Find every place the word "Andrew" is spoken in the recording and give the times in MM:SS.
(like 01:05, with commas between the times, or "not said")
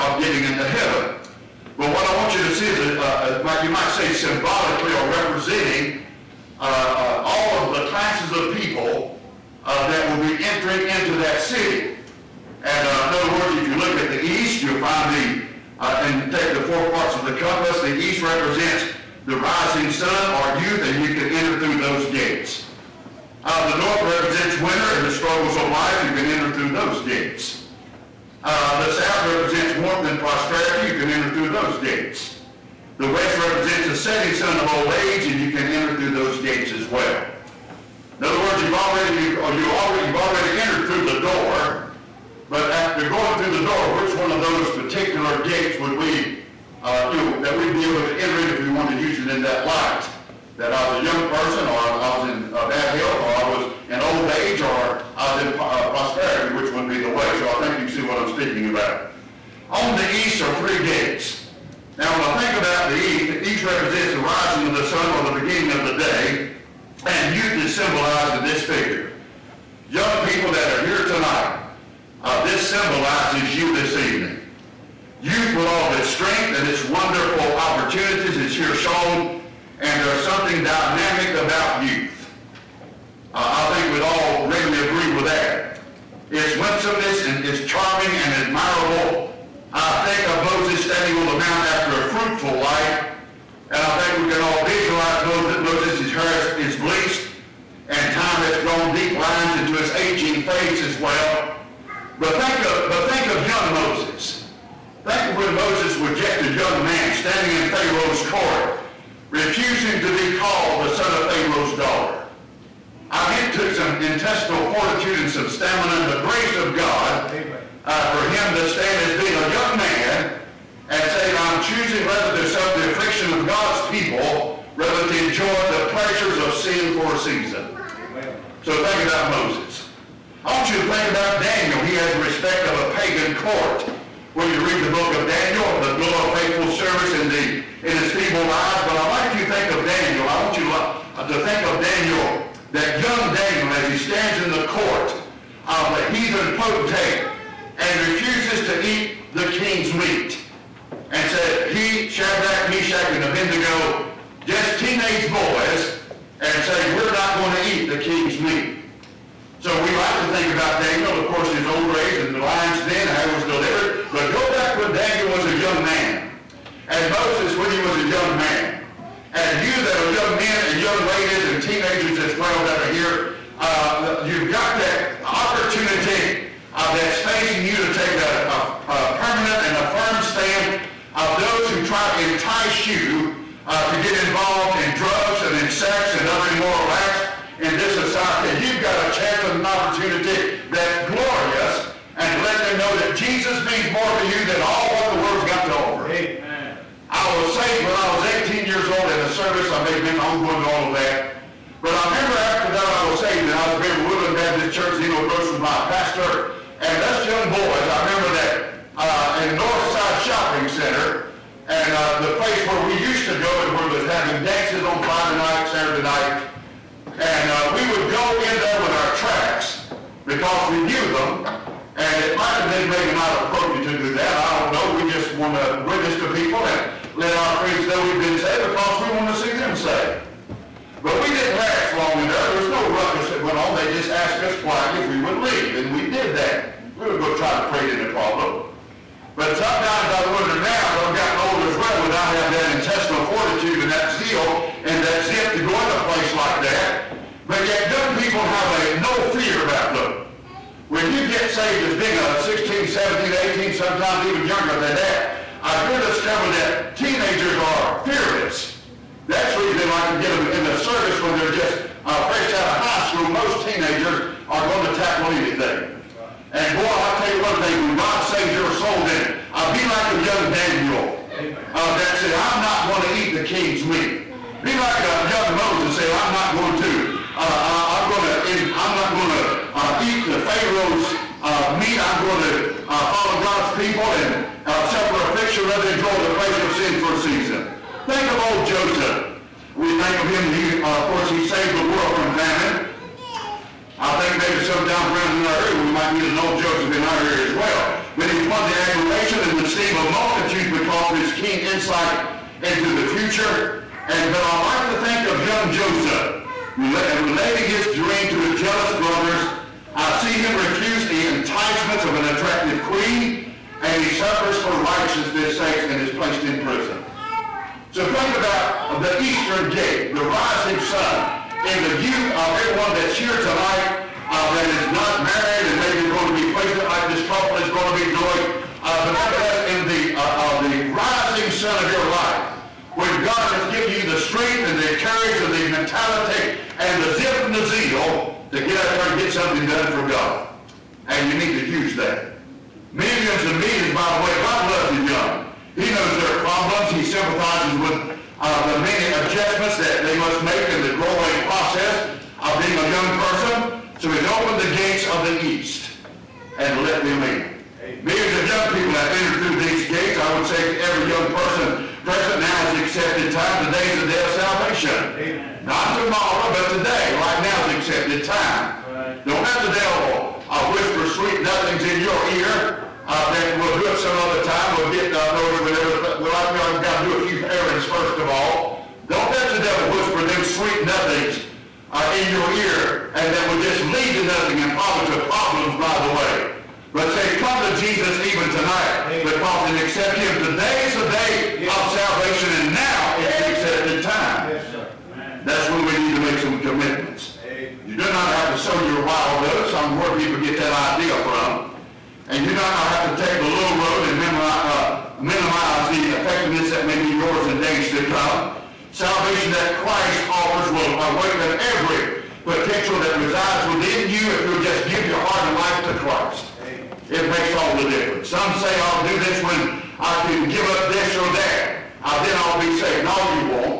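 not said.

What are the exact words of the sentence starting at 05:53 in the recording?
So he's opened the gates of the east and let them in.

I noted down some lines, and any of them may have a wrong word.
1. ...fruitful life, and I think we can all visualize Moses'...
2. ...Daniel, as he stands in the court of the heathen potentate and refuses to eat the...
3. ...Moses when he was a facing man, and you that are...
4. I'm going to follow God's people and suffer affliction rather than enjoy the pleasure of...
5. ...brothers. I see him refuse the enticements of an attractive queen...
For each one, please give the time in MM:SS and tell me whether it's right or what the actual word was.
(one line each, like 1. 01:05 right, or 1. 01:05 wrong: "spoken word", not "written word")
1. 01:32 right
2. 02:23 right
3. 02:47 wrong: "young", not "facing"
4. 04:41 right
5. 05:08 right.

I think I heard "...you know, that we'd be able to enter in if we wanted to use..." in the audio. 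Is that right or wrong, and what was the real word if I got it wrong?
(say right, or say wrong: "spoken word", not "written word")
right.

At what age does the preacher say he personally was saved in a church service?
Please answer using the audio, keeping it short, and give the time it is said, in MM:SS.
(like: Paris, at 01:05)
18, at 03:18.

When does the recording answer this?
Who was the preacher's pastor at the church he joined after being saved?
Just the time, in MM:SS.
03:25.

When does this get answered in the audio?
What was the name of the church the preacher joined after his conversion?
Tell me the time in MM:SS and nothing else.
03:24.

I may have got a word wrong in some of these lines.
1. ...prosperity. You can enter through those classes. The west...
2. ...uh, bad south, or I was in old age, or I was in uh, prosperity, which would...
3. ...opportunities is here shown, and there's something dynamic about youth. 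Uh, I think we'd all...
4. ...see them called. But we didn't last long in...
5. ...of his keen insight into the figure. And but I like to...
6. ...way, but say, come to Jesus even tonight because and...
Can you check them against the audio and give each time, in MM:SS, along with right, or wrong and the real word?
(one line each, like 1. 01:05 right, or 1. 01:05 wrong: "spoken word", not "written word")
1. 00:30 wrong: "gates", not "classes"
2. 00:52 wrong: "health", not "south"
3. 01:17 right
4. 03:49 wrong: "saved", not "called"
5. 05:01 wrong: "future", not "figure"
6. 06:26 right.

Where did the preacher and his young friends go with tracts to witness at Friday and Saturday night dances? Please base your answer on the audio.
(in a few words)
Northside Shopping Center.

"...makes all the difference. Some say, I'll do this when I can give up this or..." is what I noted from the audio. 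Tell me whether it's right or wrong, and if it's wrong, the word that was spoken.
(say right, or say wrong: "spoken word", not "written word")
right.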